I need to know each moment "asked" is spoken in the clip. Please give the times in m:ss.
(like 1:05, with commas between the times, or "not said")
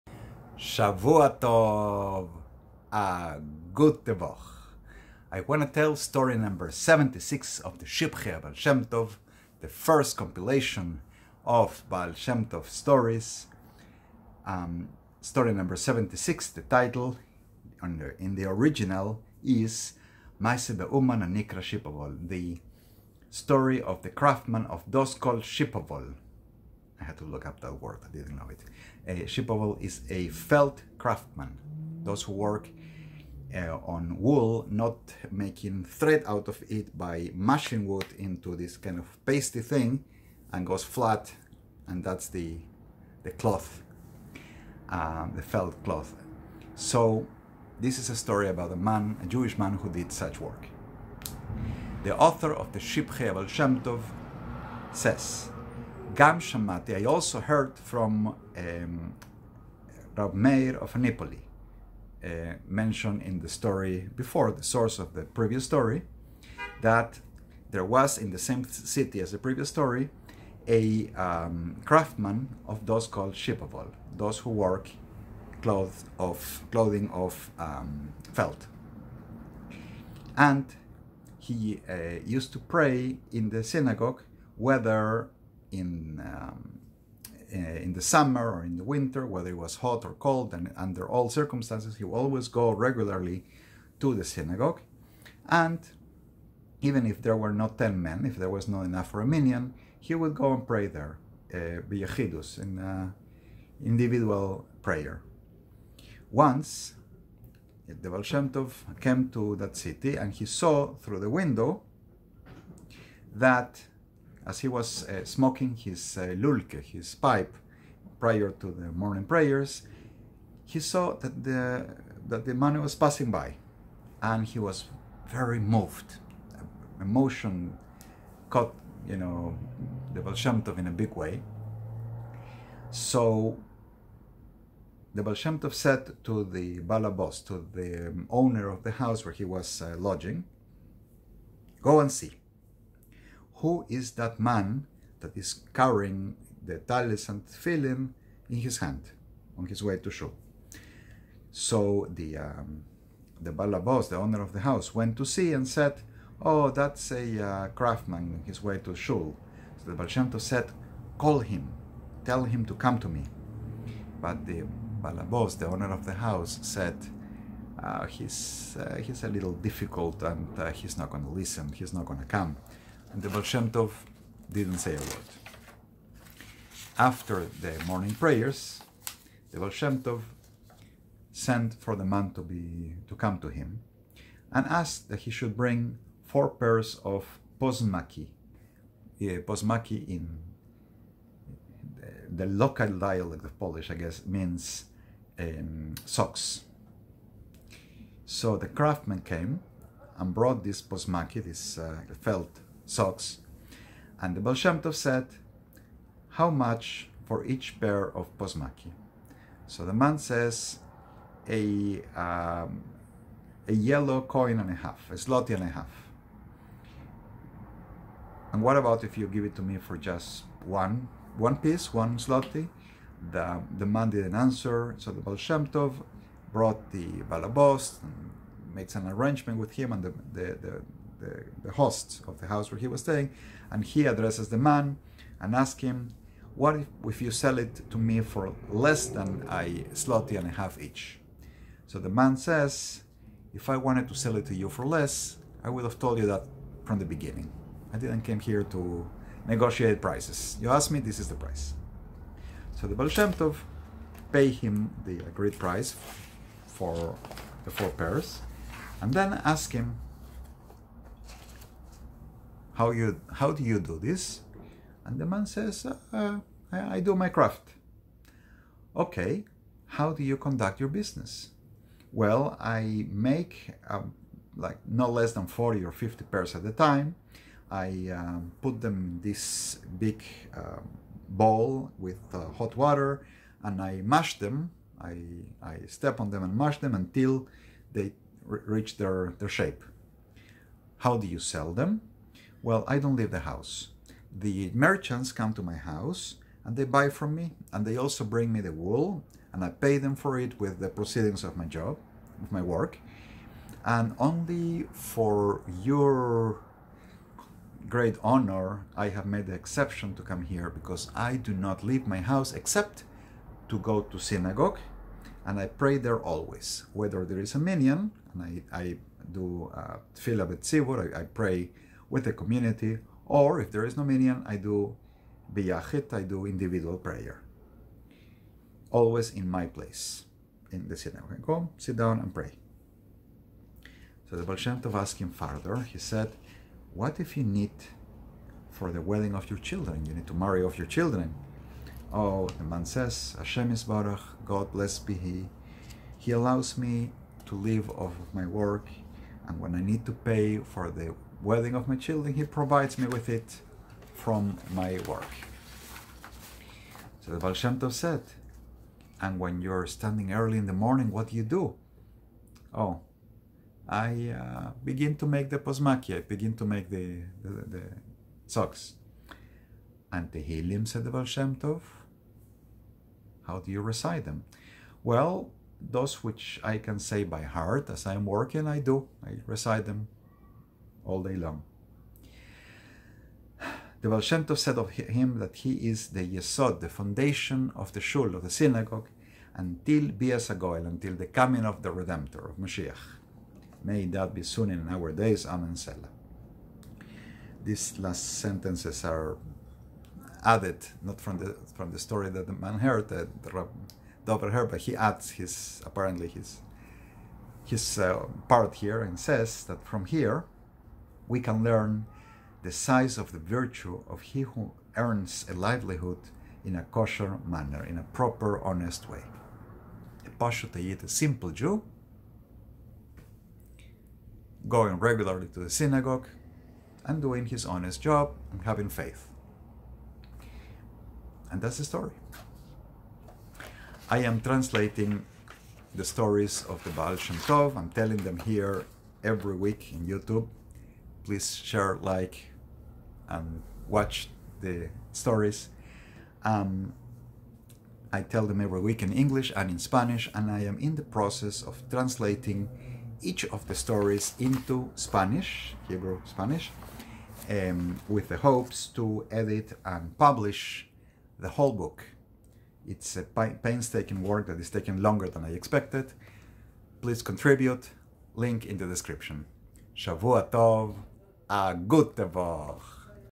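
3:04, 4:10, 5:34.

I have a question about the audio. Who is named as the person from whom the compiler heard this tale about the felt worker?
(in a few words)
Rav Meir of Napoli.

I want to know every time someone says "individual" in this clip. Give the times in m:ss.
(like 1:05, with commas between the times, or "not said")
1:43, 5:26.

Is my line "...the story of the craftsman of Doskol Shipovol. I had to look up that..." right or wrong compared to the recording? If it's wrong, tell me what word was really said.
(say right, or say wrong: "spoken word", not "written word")
right.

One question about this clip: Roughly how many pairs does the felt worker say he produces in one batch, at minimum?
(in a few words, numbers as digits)
40 or 50.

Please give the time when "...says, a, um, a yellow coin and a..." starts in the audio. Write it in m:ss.
3:30.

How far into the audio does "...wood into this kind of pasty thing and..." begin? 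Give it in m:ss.
0:37.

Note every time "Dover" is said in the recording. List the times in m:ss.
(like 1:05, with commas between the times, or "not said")
6:44.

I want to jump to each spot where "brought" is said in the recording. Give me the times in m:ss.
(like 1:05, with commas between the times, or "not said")
3:20, 3:46.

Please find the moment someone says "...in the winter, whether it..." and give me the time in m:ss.
1:28.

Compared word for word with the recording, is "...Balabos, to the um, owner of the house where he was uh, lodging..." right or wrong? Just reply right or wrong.
right.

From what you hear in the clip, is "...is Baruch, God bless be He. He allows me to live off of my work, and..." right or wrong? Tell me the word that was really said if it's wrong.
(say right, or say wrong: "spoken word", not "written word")
right.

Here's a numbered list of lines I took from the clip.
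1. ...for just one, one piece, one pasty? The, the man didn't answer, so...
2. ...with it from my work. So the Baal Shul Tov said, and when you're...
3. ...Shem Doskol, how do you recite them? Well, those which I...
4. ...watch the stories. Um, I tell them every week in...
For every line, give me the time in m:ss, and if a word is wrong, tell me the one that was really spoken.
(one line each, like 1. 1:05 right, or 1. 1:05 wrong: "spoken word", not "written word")
1. 3:39 wrong: "zloty", not "pasty"
2. 5:53 wrong: "Shem", not "Shul"
3. 6:11 wrong: "Tov", not "Doskol"
4. 7:23 right.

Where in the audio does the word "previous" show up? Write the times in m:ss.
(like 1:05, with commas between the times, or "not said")
1:05, 1:09.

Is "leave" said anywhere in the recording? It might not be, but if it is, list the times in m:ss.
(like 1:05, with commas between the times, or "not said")
4:53, 5:11.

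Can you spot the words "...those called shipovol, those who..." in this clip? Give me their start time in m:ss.
1:12.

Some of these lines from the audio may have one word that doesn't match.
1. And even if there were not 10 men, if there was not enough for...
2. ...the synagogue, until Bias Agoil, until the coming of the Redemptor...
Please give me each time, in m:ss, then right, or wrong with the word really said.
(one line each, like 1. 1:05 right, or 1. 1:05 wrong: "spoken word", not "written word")
1. 1:35 right
2. 6:28 right.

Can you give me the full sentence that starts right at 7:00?
A Pashutayit, a simple Jew, going regularly to the synagogue and doing his honest job and having faith.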